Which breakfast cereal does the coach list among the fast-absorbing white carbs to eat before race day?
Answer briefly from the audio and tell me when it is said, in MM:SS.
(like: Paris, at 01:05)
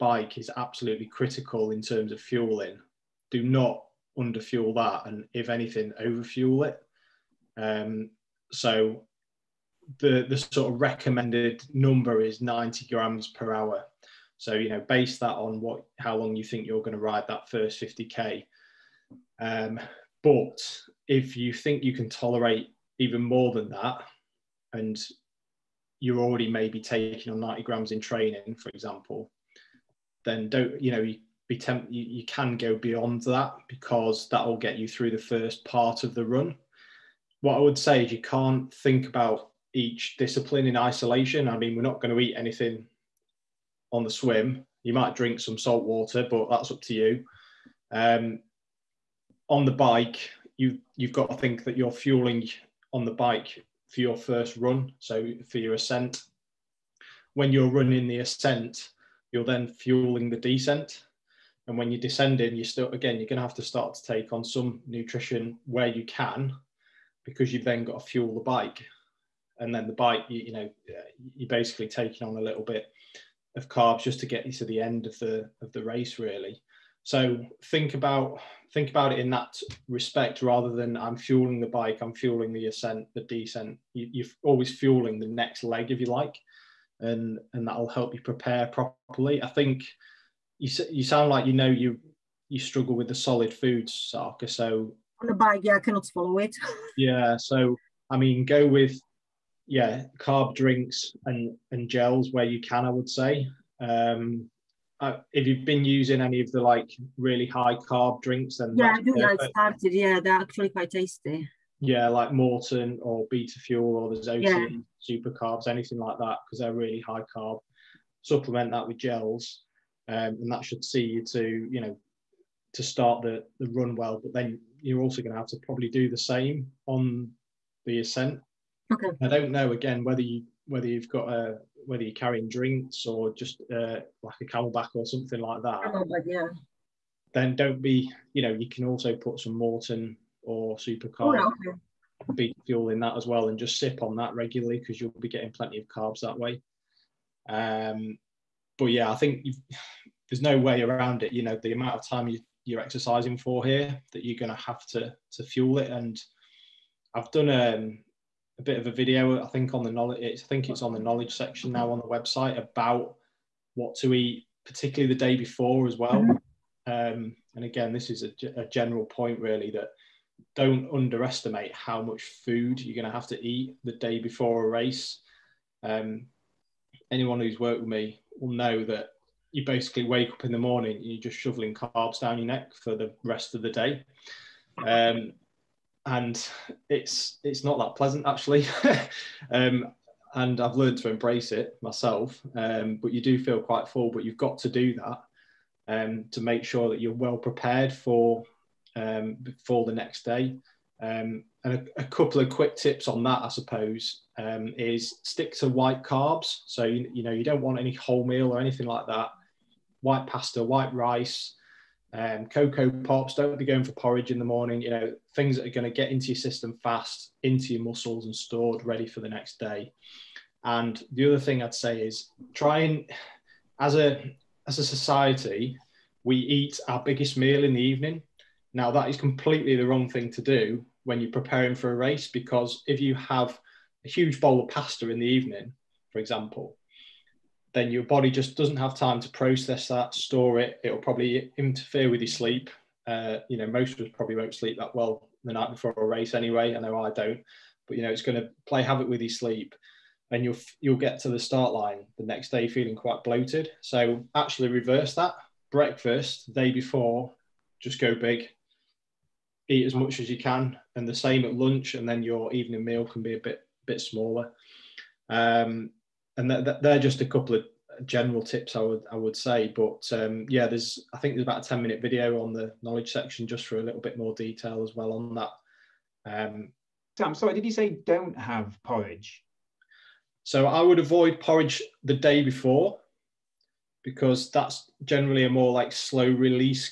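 Cocoa Pops, at 03:32.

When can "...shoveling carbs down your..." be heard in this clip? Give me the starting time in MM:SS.
03:01.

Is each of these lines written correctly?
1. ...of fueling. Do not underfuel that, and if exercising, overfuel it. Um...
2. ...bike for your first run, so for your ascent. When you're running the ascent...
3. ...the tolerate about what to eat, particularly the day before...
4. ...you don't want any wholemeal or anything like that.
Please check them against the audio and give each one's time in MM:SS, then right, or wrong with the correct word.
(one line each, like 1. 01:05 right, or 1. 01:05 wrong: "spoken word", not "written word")
1. 00:02 wrong: "anything", not "exercising"
2. 00:53 right
3. 02:41 wrong: "website", not "tolerate"
4. 03:27 right.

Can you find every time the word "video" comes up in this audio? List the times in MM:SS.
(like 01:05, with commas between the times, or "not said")
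02:38, 04:32.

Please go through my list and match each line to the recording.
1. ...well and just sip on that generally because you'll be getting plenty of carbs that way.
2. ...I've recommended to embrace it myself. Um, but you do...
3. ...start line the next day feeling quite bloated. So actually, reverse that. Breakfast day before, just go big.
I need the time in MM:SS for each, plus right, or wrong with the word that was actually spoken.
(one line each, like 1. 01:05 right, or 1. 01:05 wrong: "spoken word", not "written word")
1. 02:23 wrong: "regularly", not "generally"
2. 03:10 wrong: "learned", not "recommended"
3. 04:11 right.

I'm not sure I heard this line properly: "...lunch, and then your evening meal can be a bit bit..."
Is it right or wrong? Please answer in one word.
right.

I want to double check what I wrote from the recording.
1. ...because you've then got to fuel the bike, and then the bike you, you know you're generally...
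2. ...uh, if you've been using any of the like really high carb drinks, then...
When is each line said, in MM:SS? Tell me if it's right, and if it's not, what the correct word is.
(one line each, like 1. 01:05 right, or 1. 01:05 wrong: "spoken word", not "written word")
1. 01:07 wrong: "basically", not "generally"
2. 01:45 right.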